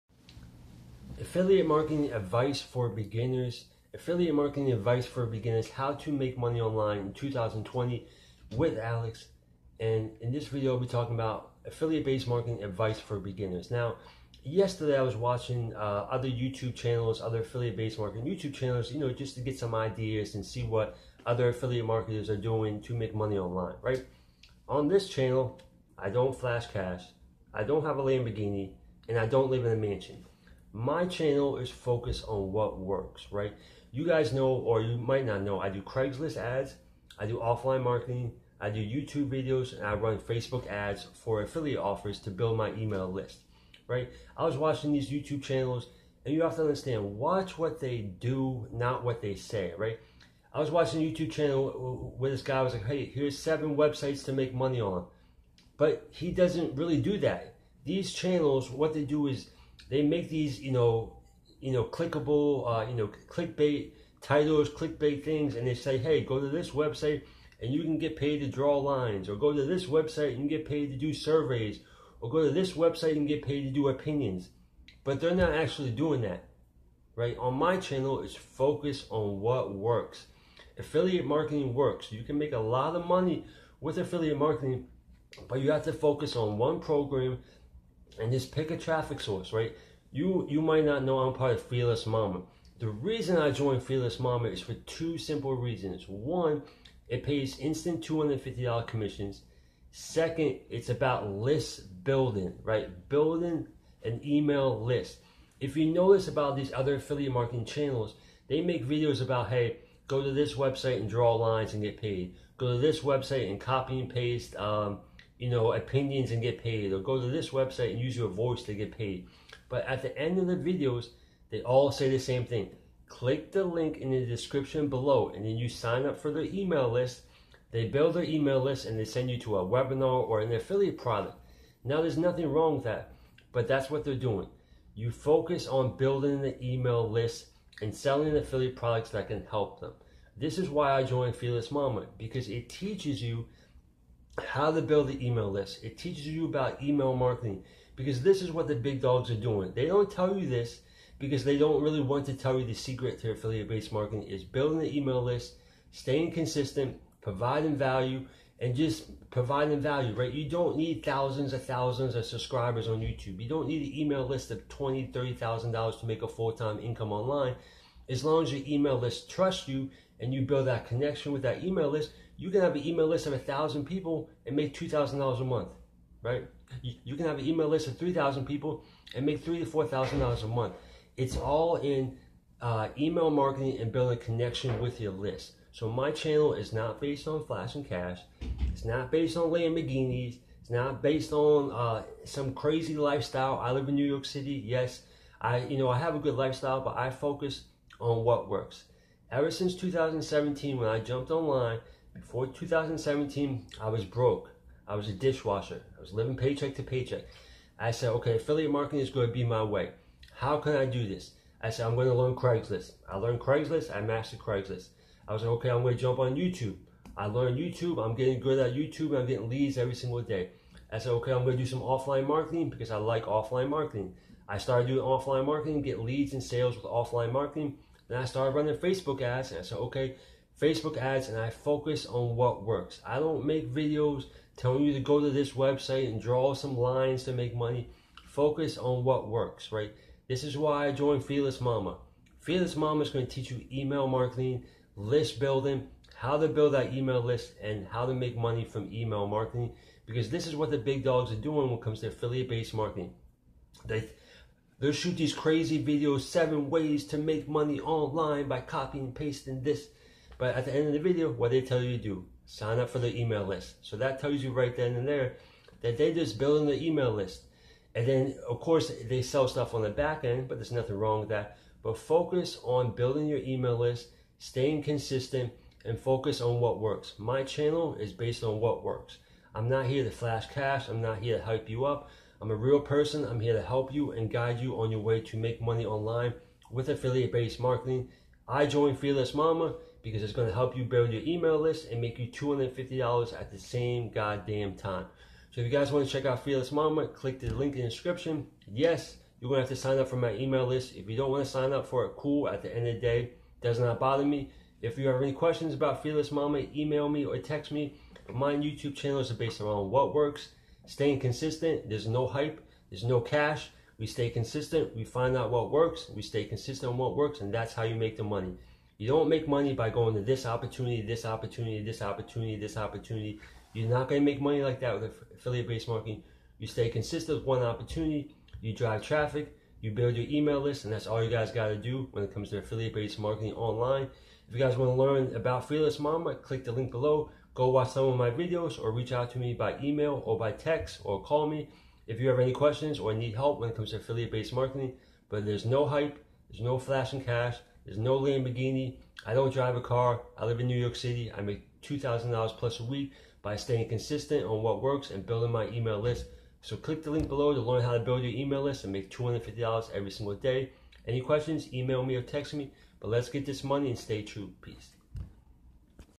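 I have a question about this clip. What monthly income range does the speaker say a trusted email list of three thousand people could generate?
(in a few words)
$3,000 to $4,000.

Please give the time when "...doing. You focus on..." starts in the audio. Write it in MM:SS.
02:14.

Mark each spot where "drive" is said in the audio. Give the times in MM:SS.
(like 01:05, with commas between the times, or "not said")
05:28, 05:49.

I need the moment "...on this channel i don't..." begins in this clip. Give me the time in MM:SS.
00:24.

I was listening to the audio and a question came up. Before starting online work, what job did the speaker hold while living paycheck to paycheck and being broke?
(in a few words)
Dishwasher.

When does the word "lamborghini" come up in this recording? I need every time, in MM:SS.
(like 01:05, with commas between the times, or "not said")
00:28, 03:09, 05:48.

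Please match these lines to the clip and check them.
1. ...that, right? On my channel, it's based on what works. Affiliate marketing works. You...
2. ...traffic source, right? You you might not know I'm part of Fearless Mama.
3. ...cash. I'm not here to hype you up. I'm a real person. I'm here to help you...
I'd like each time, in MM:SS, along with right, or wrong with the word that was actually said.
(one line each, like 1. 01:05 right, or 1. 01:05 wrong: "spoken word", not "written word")
1. 01:16 wrong: "focused", not "based"
2. 01:28 right
3. 04:40 right.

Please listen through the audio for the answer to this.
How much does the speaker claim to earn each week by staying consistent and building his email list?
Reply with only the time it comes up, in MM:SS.
05:51.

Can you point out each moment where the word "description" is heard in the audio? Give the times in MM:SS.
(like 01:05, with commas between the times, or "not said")
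02:04, 04:57.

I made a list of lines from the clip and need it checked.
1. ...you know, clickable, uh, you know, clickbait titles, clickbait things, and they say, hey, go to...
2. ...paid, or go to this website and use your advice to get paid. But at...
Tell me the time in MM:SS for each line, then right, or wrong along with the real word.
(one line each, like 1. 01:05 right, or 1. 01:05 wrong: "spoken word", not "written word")
1. 01:01 right
2. 01:56 wrong: "voice", not "advice".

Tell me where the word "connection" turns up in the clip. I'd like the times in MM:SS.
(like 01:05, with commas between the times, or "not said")
02:50, 03:04.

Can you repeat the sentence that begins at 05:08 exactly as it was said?
My YouTube channel is based around what works staying consistent.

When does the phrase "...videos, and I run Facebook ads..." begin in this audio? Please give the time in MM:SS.
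00:39.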